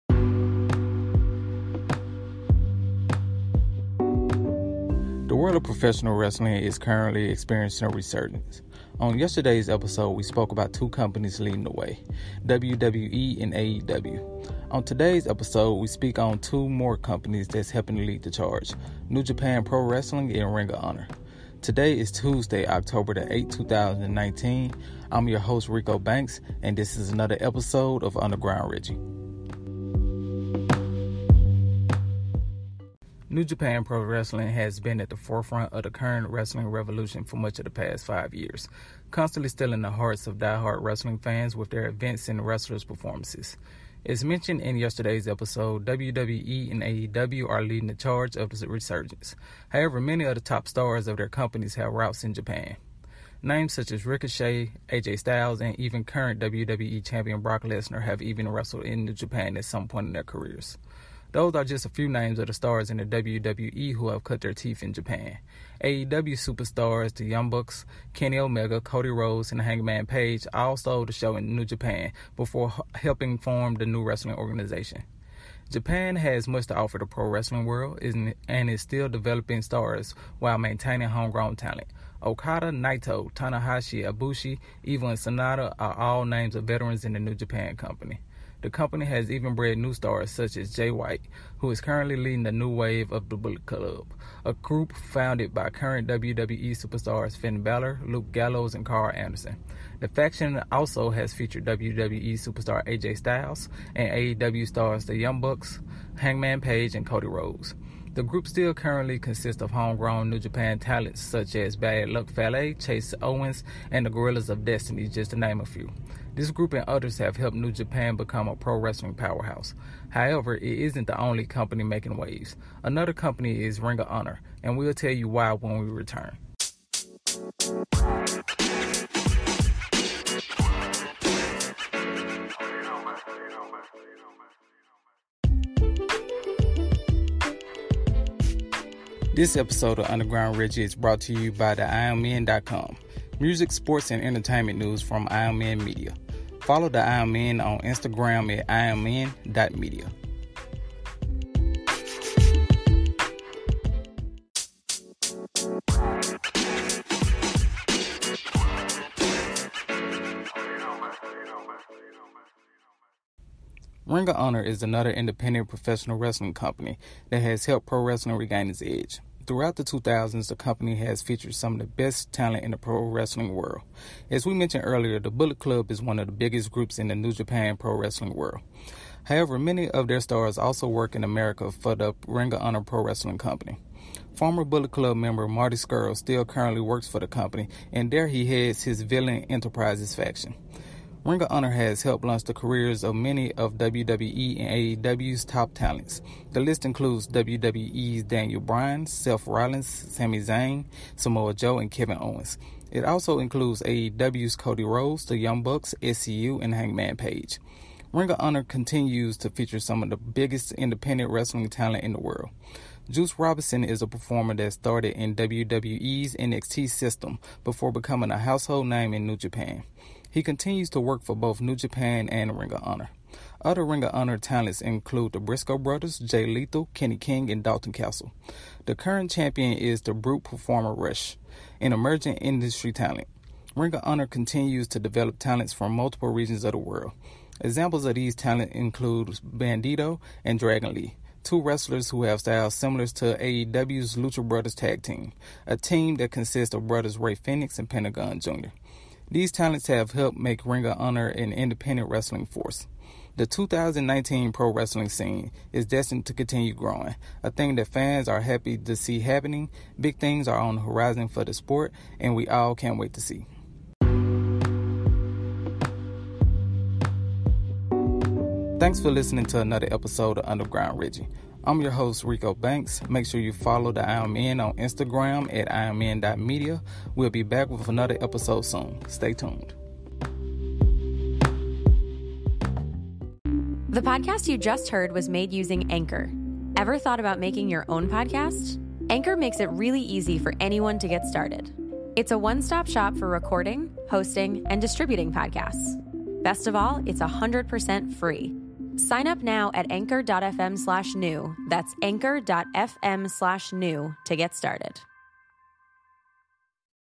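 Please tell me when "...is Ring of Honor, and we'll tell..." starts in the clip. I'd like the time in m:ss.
2:03.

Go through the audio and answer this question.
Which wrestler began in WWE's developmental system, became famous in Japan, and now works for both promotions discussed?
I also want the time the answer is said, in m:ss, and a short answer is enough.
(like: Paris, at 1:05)
Juice Robinson, at 3:33.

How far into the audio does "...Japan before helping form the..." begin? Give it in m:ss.
1:11.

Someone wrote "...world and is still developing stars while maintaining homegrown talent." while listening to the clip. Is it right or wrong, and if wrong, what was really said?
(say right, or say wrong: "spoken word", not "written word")
right.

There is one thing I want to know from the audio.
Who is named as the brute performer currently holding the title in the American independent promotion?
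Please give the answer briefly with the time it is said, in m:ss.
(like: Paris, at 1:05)
Rush, at 3:50.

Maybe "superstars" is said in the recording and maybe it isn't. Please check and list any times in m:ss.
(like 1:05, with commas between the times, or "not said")
1:06, 1:36, 1:42.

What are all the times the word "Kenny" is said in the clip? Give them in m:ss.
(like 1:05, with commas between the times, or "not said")
1:08, 3:46.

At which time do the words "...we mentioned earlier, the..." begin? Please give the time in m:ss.
2:54.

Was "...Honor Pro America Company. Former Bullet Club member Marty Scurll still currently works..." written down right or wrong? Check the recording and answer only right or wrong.
wrong.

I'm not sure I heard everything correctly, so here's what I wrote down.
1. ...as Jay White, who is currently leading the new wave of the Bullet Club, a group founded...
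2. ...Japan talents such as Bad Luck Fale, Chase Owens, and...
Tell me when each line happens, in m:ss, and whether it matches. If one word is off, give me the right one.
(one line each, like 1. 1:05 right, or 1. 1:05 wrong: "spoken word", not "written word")
1. 1:30 right
2. 1:50 right.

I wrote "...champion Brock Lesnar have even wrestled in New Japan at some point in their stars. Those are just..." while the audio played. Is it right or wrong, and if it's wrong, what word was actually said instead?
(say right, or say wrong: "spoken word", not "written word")
wrong: "careers", not "stars".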